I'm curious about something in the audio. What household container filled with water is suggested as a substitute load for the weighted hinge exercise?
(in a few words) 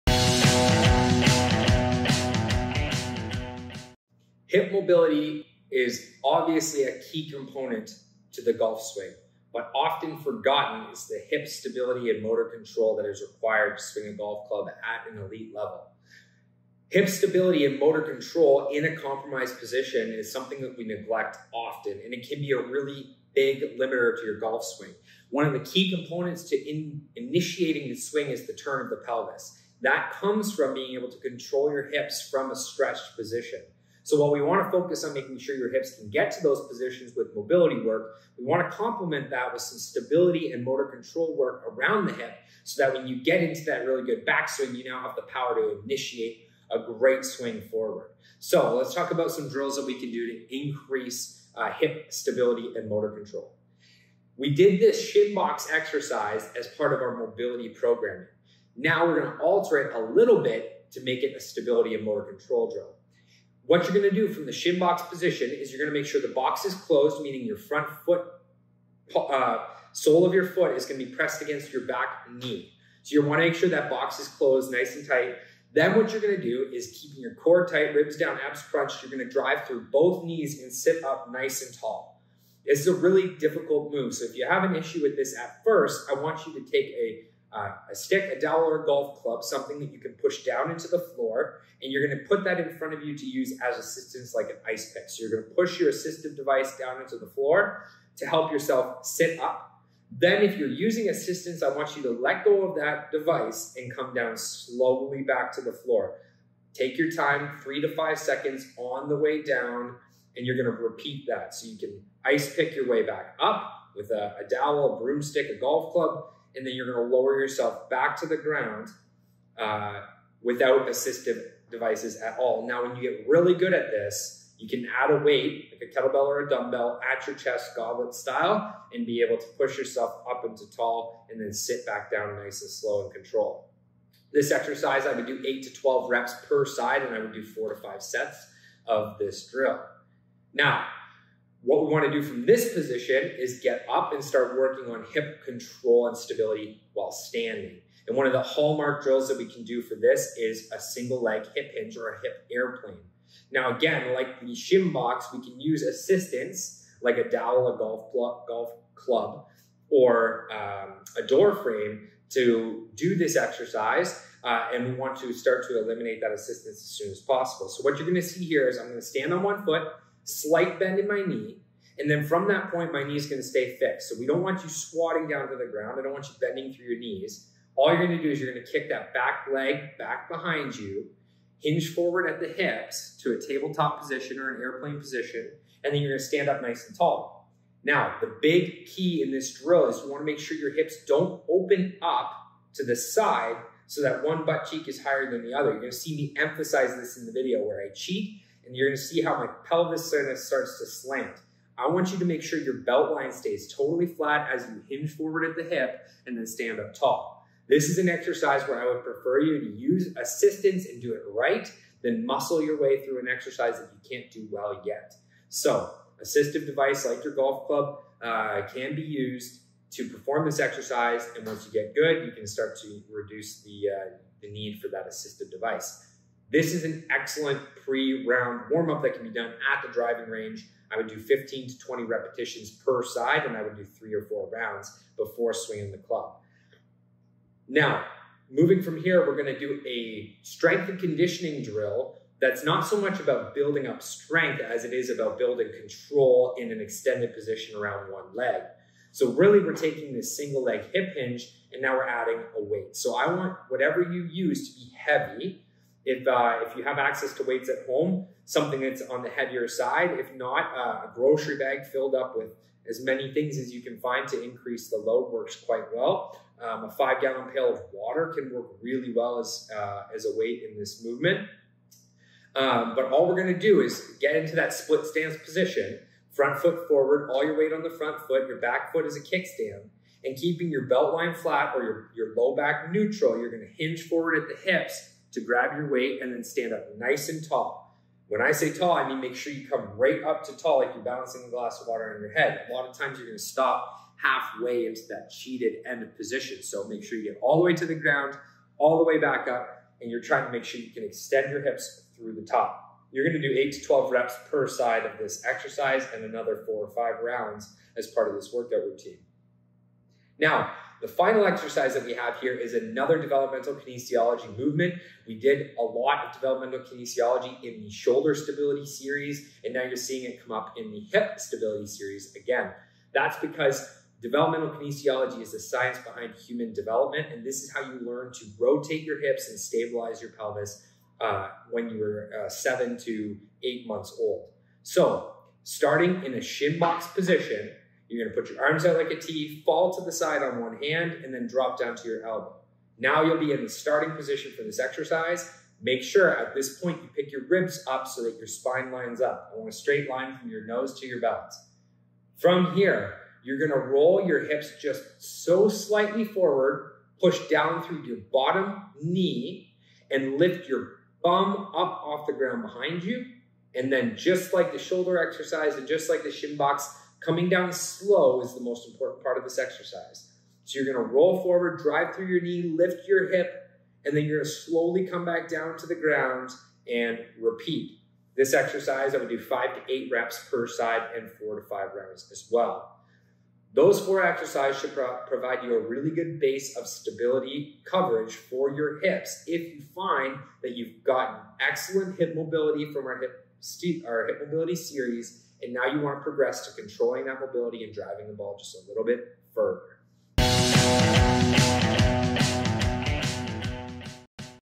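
five gallon pail.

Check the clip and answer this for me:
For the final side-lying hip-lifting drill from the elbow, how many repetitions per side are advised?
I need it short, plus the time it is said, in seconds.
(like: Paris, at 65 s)
5 to 8, at 379 s.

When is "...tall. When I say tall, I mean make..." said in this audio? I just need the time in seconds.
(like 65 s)
287 s.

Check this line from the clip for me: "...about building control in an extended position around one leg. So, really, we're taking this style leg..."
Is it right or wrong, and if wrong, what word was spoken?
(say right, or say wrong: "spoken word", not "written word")
wrong: "single", not "style".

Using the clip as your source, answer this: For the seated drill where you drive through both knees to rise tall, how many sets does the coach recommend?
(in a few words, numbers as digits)
4 to 5.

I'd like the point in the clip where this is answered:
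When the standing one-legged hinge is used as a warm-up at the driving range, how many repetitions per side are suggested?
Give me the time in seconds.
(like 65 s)
231 s.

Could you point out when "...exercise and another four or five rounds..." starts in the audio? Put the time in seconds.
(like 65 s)
305 s.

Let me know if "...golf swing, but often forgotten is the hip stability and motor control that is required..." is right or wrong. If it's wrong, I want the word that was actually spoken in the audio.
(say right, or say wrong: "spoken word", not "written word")
right.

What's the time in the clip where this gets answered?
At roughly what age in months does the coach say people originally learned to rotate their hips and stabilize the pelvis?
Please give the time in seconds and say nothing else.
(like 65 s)
332 s.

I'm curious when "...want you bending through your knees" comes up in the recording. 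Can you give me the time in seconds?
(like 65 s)
176 s.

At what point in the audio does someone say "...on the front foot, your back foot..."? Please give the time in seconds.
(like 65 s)
277 s.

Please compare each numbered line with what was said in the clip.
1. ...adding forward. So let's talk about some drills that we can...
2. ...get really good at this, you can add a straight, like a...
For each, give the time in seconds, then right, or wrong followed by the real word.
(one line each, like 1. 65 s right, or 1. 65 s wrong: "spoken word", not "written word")
1. 47 s wrong: "swing", not "adding"
2. 123 s wrong: "weight", not "straight".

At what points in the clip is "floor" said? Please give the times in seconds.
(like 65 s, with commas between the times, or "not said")
90 s, 97 s, 105 s.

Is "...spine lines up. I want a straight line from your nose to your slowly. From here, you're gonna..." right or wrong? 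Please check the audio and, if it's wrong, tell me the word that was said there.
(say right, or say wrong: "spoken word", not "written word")
wrong: "belly", not "slowly".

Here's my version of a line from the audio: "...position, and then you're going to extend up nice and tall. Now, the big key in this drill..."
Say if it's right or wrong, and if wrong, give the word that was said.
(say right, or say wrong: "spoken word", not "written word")
wrong: "stand", not "extend".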